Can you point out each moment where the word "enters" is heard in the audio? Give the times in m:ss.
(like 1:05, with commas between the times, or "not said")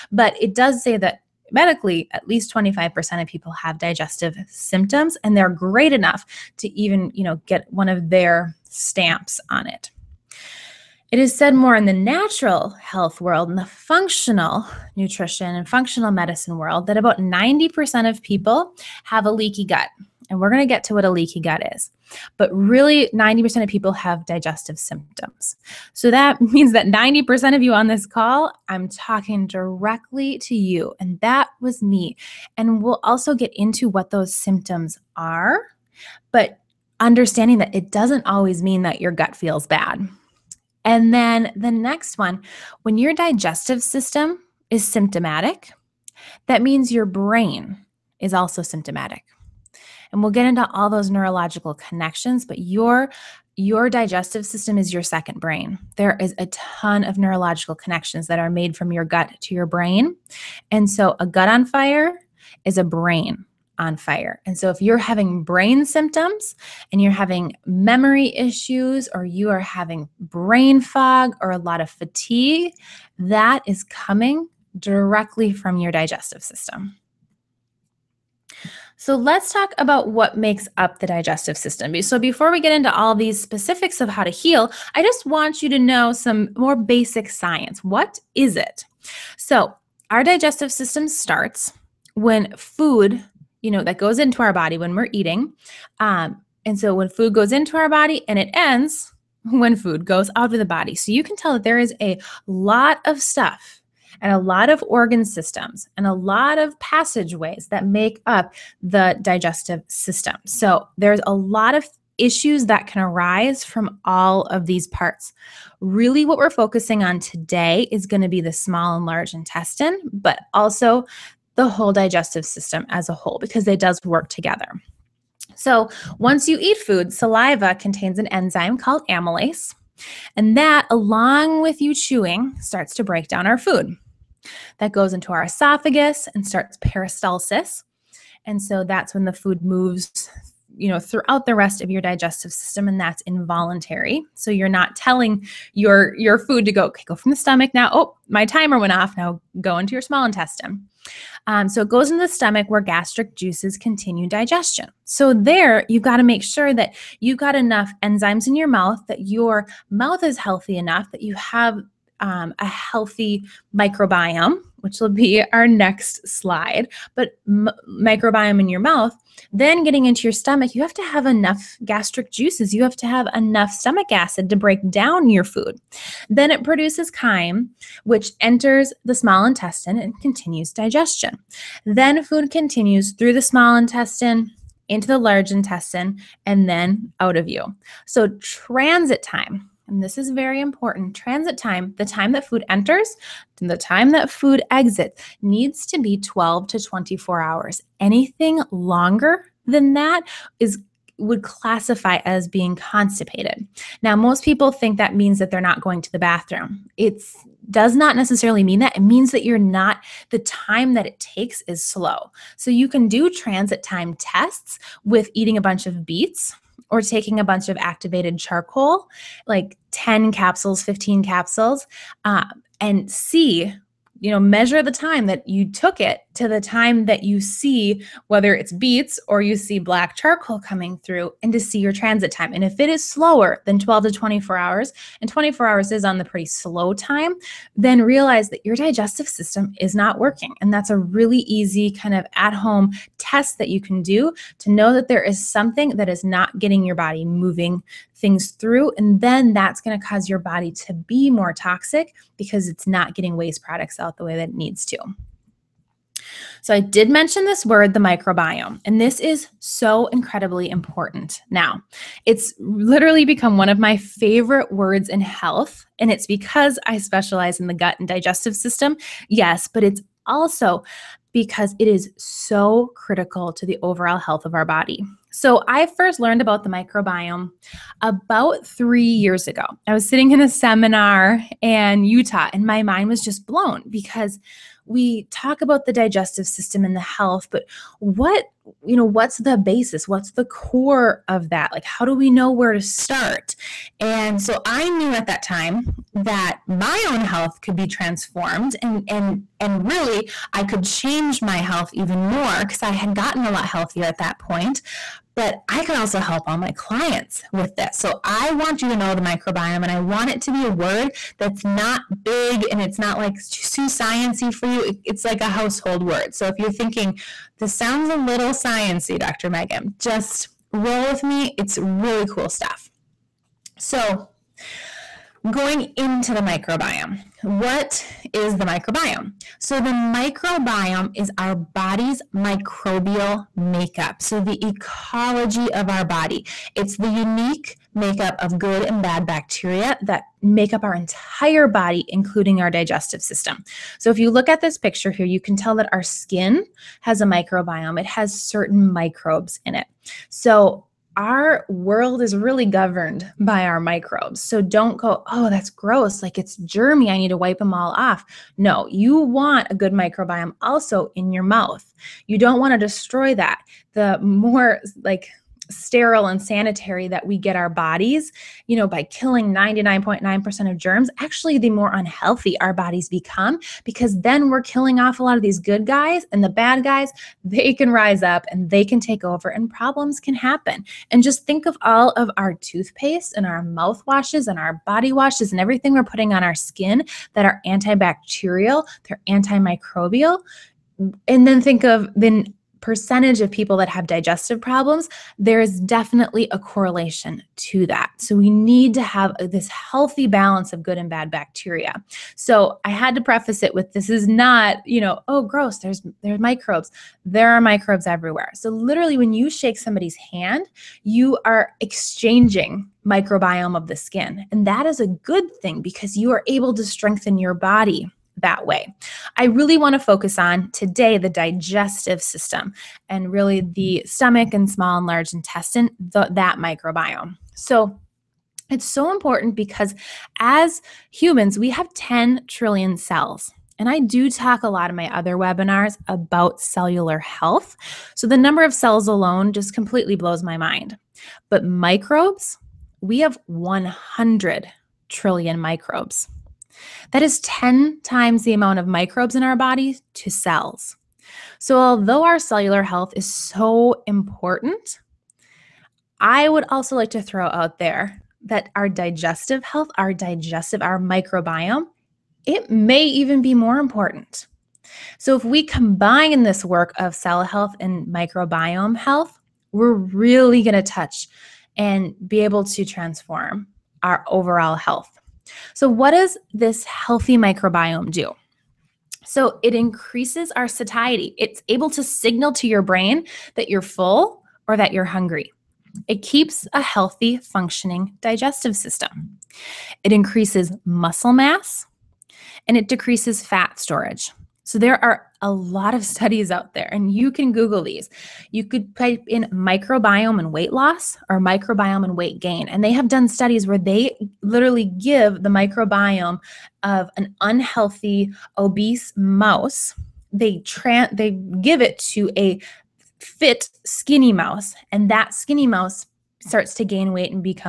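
2:58, 3:12.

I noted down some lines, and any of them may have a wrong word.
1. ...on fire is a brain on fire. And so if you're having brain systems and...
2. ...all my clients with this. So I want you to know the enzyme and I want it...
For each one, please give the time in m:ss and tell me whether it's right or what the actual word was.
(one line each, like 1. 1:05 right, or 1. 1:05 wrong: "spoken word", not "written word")
1. 1:01 wrong: "symptoms", not "systems"
2. 5:06 wrong: "microbiome", not "enzyme".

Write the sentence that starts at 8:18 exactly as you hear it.
You could type in microbiome and weight loss or microbiome and weight gain.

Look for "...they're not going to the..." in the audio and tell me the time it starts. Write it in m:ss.
3:25.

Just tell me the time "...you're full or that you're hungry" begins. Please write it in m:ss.
8:03.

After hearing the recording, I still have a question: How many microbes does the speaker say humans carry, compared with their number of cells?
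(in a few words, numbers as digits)
100 trillion.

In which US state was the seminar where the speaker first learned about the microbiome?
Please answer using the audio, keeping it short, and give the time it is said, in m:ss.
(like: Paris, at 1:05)
Utah, at 4:42.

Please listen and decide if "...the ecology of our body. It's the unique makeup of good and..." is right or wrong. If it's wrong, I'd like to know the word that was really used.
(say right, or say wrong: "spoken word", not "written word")
right.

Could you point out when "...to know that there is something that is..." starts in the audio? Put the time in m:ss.
4:04.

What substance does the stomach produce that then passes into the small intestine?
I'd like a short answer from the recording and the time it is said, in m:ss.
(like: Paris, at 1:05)
chyme, at 2:57.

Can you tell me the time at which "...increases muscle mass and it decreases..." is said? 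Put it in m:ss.
8:10.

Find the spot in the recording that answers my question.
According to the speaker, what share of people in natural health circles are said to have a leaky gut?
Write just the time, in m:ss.
0:16.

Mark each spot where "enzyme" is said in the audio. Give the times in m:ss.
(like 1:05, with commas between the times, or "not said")
2:08, 2:38.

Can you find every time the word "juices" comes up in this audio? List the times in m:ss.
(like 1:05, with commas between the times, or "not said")
2:33, 2:52.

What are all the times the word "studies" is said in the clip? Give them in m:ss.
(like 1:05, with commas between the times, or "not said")
8:16, 8:23.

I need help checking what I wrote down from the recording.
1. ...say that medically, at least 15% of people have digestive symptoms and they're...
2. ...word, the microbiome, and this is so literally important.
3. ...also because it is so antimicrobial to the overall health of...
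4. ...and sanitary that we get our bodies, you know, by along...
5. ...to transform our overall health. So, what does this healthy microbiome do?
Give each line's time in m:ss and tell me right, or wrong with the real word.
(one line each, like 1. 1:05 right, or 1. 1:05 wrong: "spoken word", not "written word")
1. 0:00 wrong: "25", not "15"
2. 4:17 wrong: "incredibly", not "literally"
3. 4:30 wrong: "critical", not "antimicrobial"
4. 6:06 wrong: "killing", not "along"
5. 7:52 right.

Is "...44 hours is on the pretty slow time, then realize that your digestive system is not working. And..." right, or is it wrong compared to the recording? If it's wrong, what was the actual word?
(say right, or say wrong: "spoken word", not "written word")
wrong: "24", not "44".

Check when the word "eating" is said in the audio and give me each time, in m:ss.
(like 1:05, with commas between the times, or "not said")
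1:35, 3:35.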